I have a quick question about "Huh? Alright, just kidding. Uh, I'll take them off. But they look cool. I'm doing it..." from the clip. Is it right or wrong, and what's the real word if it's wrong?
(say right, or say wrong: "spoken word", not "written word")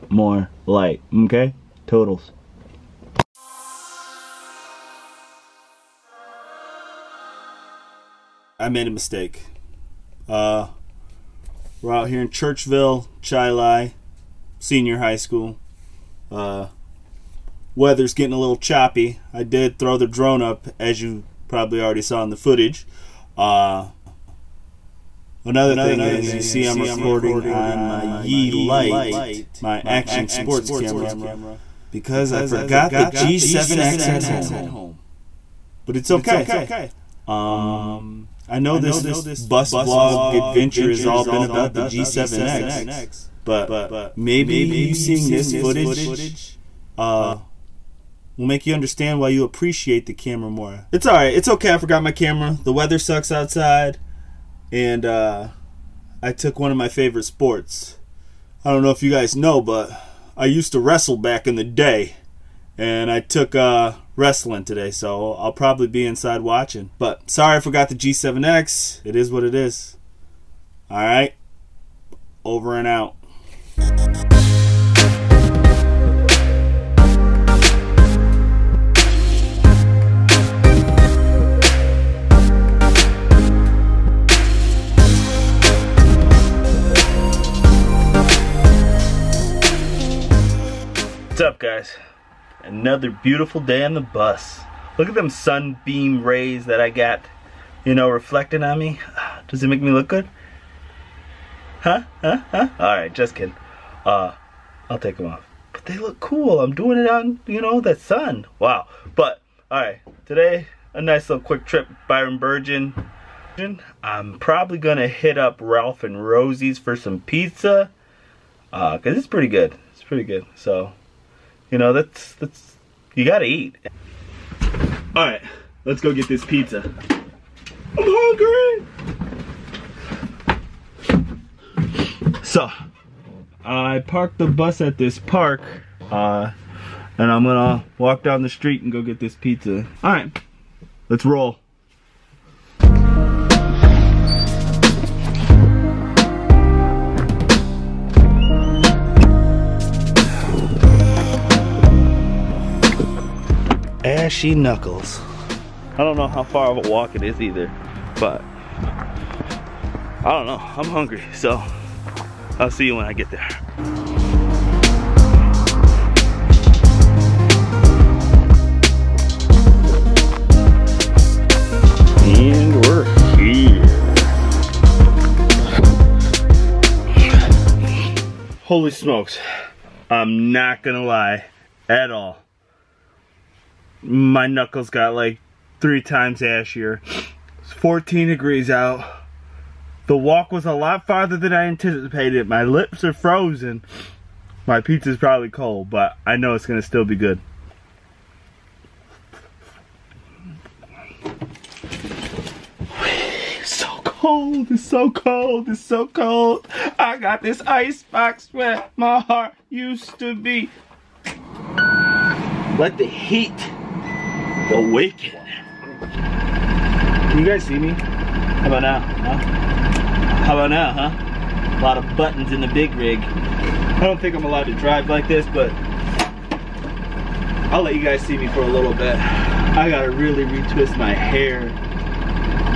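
right.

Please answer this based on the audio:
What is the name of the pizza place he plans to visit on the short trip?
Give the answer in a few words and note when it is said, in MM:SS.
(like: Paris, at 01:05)
Ralph and Rosie's, at 01:55.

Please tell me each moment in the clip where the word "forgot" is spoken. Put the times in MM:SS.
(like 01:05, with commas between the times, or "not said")
00:32, 00:51, 01:07.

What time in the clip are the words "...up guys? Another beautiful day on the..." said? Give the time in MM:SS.
01:31.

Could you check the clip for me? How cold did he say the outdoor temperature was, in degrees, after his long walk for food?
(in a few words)
14 degrees.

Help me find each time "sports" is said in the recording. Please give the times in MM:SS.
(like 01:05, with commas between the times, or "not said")
00:30, 00:57.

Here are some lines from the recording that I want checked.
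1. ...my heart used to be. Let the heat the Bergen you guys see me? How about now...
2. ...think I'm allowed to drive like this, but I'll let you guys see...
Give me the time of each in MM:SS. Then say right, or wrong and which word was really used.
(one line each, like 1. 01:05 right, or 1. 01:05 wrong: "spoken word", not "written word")
1. 03:28 wrong: "Can", not "Bergen"
2. 03:44 right.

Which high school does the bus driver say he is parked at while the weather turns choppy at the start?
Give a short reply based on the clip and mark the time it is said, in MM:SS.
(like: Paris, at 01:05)
Churchville Chili Senior High School, at 00:12.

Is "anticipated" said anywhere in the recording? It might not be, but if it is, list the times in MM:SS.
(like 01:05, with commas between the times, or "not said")
03:11.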